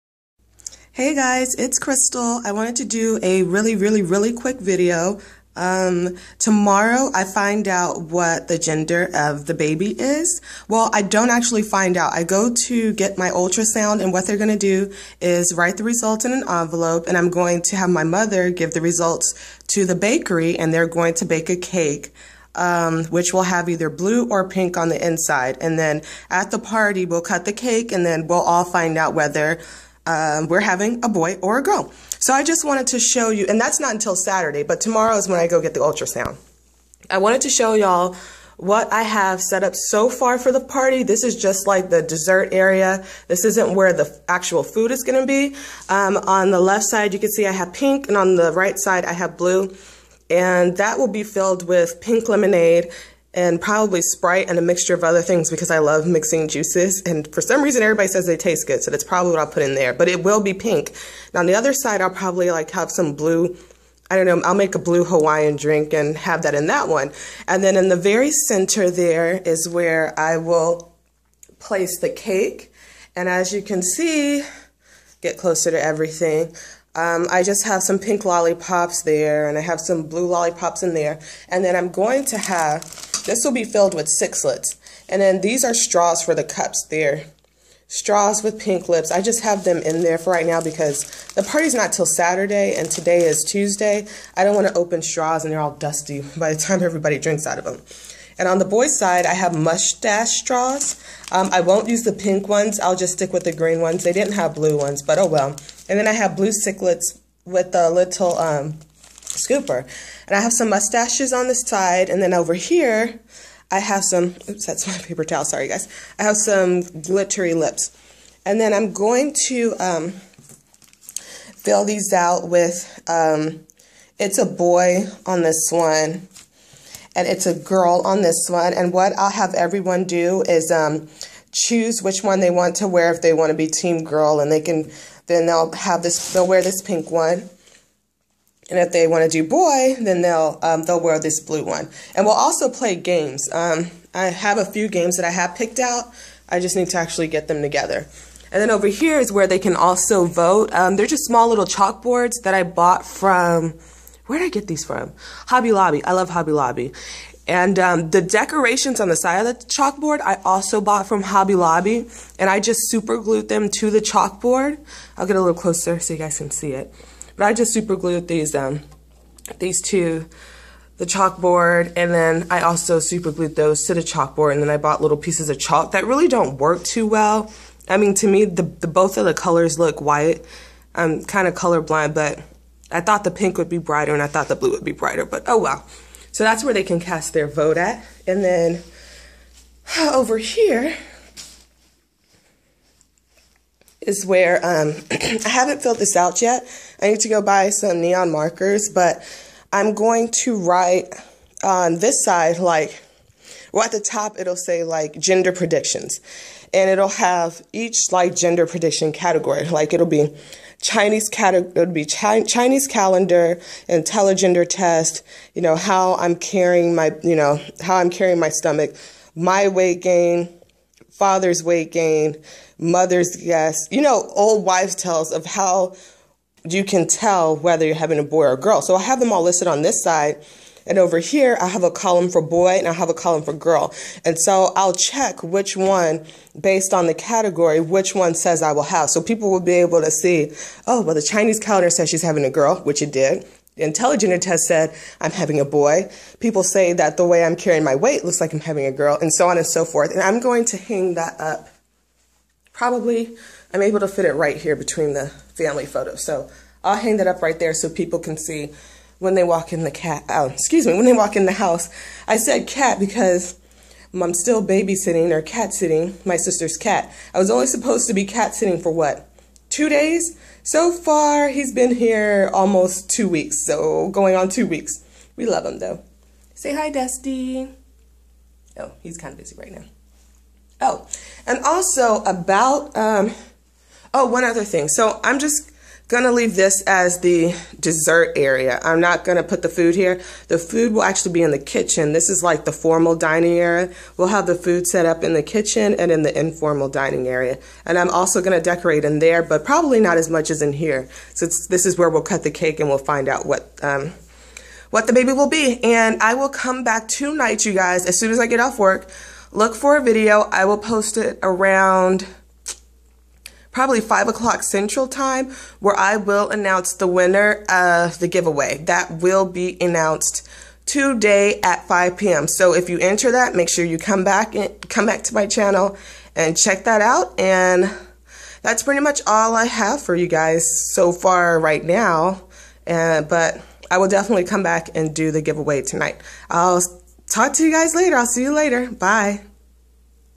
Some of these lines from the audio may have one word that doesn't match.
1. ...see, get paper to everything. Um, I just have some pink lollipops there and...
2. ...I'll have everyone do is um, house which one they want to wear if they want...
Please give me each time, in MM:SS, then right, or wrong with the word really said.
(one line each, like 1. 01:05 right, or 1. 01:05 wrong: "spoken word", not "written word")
1. 01:13 wrong: "closer", not "paper"
2. 02:09 wrong: "choose", not "house".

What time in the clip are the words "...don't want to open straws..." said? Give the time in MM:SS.
01:34.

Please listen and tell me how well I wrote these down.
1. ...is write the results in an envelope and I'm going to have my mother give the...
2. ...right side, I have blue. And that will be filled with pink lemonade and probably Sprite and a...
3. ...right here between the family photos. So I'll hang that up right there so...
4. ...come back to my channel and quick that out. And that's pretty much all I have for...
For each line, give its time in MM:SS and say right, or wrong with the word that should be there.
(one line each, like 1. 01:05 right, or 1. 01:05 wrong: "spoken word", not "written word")
1. 00:15 right
2. 00:48 right
3. 04:14 right
4. 05:24 wrong: "check", not "quick".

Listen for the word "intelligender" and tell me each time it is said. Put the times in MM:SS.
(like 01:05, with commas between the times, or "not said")
03:33, 04:03.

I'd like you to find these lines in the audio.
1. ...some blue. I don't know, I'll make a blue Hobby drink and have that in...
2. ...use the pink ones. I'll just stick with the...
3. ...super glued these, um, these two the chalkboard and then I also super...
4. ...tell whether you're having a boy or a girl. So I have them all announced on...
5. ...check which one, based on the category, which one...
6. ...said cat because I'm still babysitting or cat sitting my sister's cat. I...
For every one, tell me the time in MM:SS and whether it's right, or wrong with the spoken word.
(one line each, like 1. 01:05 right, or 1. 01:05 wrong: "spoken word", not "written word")
1. 01:02 wrong: "Hawaiian", not "Hobby"
2. 01:41 right
3. 02:47 right
4. 03:47 wrong: "listed", not "announced"
5. 03:54 right
6. 04:22 right.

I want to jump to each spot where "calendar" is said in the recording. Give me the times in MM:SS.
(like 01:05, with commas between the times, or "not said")
03:32, 04:01.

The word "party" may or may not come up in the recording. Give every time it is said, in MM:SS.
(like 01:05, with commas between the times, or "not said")
00:26, 00:40, 01:31.